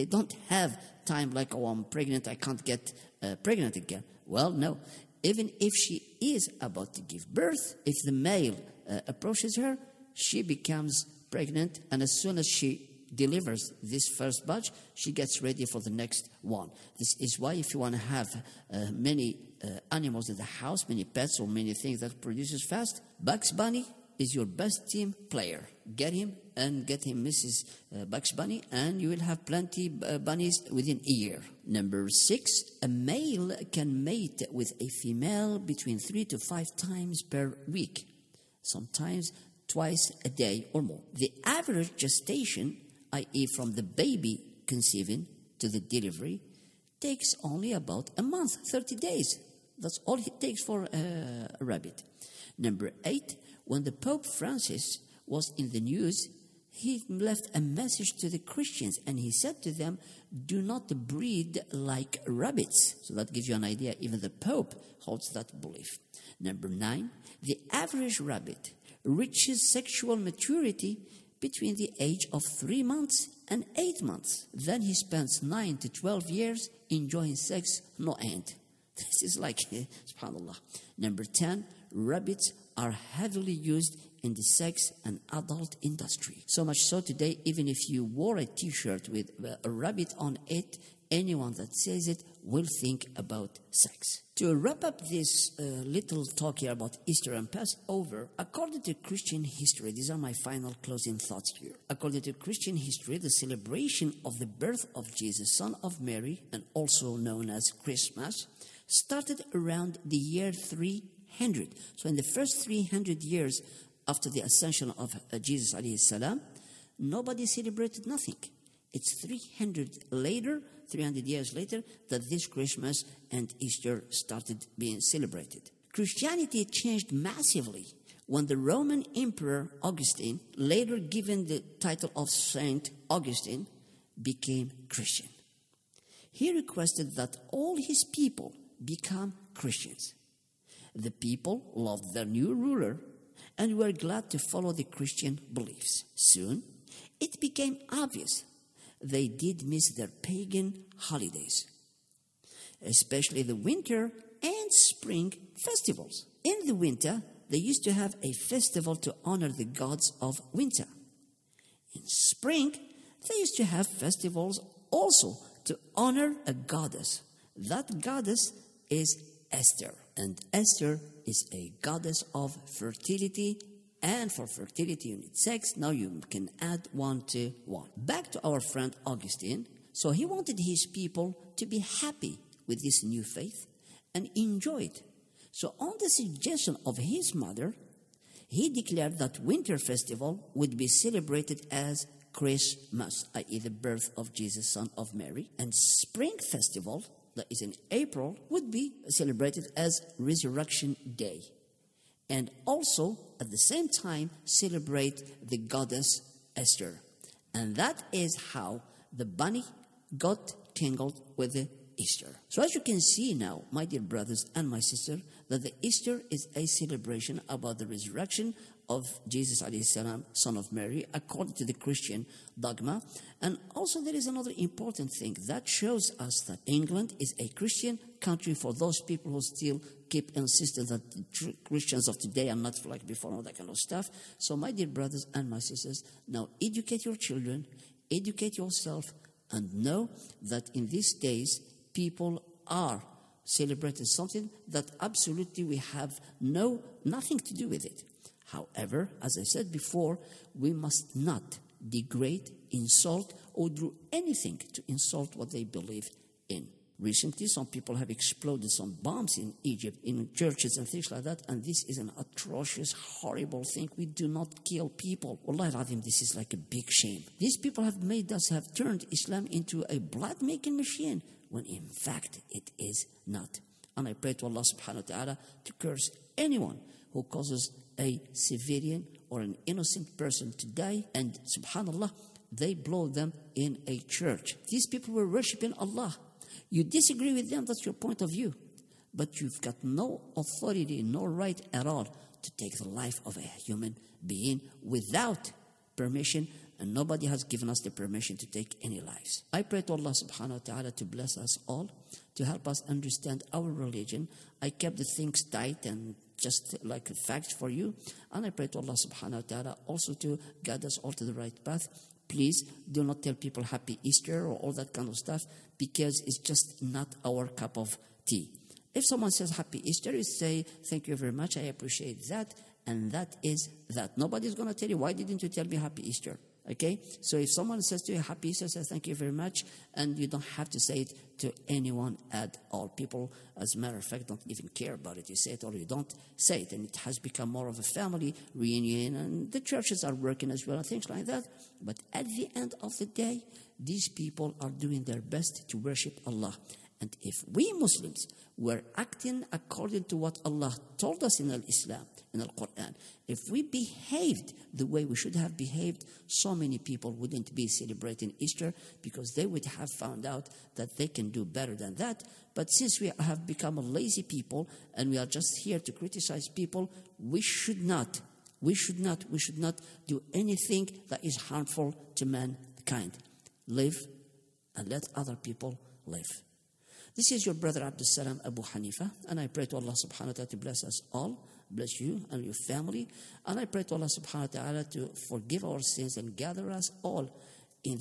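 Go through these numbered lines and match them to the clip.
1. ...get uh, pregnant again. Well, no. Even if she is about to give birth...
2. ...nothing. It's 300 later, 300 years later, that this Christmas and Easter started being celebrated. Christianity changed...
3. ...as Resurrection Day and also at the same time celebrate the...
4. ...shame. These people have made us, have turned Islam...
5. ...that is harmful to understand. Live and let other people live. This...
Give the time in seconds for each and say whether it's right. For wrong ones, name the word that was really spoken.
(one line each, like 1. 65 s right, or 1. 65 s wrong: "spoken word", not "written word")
1. 2 s right
2. 118 s right
3. 199 s right
4. 266 s right
5. 371 s wrong: "mankind", not "understand".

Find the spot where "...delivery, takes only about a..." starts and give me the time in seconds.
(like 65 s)
45 s.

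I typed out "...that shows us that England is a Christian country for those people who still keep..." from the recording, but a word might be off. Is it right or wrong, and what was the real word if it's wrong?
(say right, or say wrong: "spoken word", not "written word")
right.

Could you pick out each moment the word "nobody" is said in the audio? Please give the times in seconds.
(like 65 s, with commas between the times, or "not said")
116 s, 296 s, 324 s.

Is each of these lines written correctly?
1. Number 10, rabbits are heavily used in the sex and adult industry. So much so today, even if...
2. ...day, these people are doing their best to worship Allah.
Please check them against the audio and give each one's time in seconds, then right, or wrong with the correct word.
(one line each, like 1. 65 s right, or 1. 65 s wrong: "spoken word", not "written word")
1. 80 s right
2. 343 s right.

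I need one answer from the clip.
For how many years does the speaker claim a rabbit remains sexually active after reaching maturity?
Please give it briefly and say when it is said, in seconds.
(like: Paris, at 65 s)
9 to 12 years, at 75 s.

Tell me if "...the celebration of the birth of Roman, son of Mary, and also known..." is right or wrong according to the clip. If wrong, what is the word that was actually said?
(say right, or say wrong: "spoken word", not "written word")
wrong: "Jesus", not "Roman".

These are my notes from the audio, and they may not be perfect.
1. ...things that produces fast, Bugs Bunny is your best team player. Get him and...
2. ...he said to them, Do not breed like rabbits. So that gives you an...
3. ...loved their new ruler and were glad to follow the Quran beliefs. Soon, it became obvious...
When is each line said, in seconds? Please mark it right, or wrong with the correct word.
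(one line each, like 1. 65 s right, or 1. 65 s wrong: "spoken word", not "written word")
1. 21 s right
2. 59 s right
3. 141 s wrong: "Christian", not "Quran".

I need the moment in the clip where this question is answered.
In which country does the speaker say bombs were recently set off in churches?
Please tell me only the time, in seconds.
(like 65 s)
259 s.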